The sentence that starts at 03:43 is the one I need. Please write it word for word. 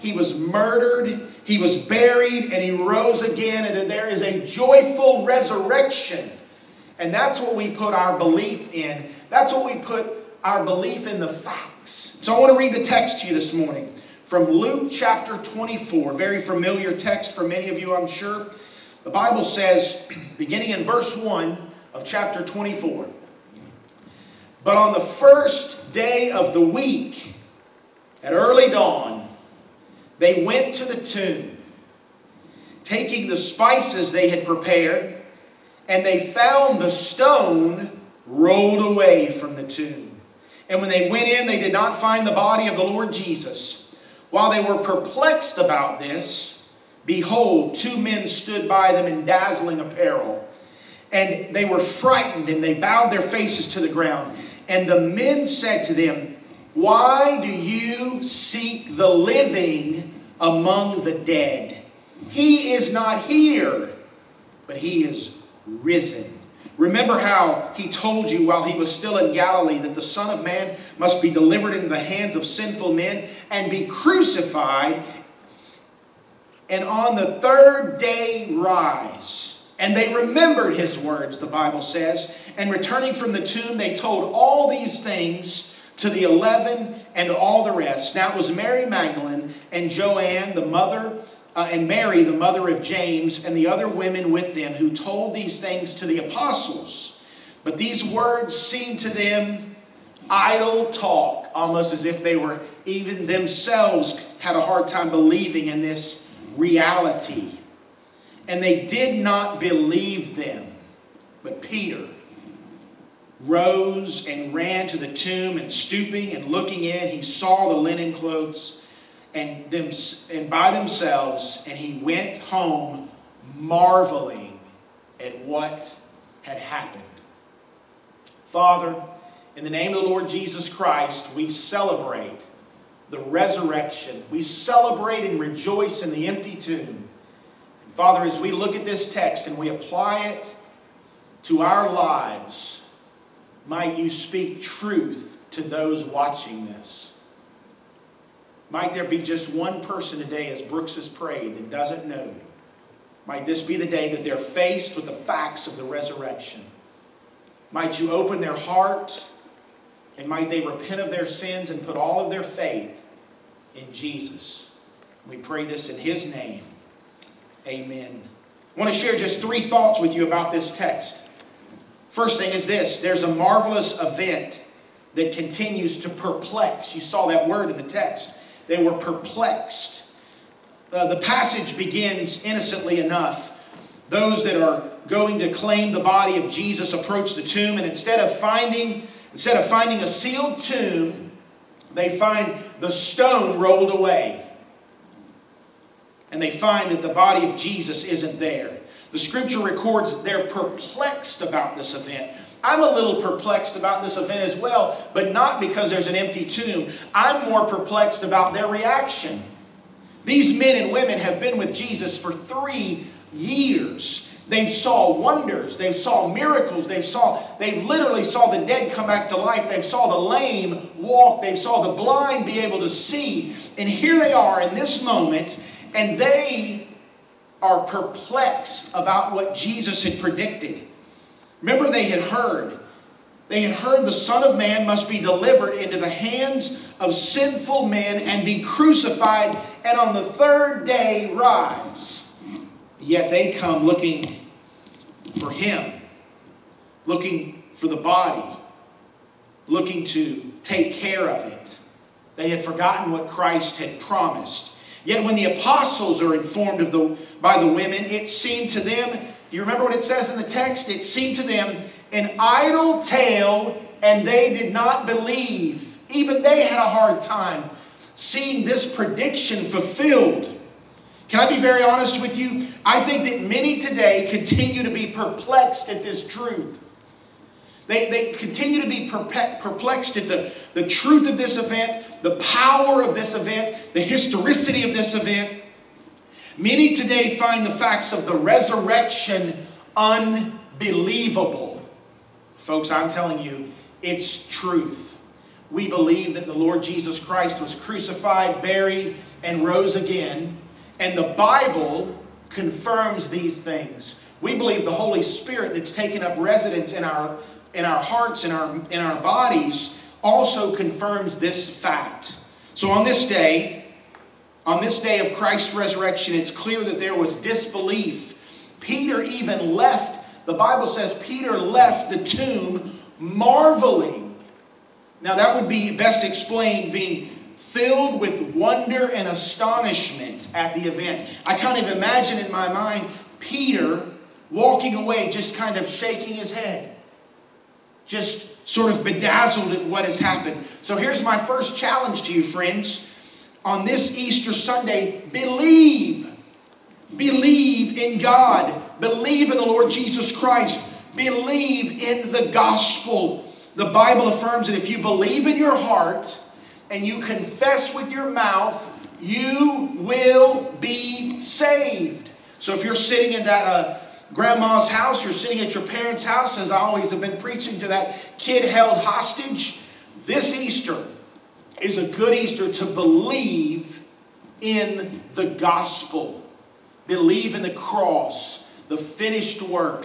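And here they are in this moment, and they are perplexed about what Jesus had predicted.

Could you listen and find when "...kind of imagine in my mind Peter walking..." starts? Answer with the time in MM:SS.
05:31.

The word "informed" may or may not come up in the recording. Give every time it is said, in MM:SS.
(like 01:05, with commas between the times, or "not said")
04:16.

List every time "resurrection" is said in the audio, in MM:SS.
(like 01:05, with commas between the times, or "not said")
00:05, 02:13, 02:35, 04:48, 05:15.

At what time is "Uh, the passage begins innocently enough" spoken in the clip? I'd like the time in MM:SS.
03:00.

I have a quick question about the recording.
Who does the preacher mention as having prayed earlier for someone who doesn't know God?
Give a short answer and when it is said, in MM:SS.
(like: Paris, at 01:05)
Brooks, at 02:30.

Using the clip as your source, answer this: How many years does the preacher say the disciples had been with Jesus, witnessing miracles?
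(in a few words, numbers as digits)
3.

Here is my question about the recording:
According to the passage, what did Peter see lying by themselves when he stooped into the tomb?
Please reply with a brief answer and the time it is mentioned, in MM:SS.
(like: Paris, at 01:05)
linen clothes, at 01:57.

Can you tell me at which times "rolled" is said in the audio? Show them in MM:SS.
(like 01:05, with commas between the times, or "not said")
00:38, 03:13.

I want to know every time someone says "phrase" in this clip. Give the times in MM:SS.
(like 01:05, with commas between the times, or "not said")
not said.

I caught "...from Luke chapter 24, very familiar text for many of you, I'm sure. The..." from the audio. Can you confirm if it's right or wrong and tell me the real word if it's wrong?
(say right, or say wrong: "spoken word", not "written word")
right.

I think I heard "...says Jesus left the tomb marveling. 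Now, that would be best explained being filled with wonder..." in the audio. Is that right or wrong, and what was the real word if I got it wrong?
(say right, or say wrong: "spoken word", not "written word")
wrong: "Peter", not "Jesus".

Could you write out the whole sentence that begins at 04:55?
We believe that the Lord Jesus Christ was crucified, buried, and rose again.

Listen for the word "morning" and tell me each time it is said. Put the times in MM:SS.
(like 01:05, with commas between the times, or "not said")
00:13.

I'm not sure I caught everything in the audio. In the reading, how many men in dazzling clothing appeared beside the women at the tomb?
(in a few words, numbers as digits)
2.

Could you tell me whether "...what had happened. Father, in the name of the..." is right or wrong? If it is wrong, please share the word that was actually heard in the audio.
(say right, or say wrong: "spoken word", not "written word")
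right.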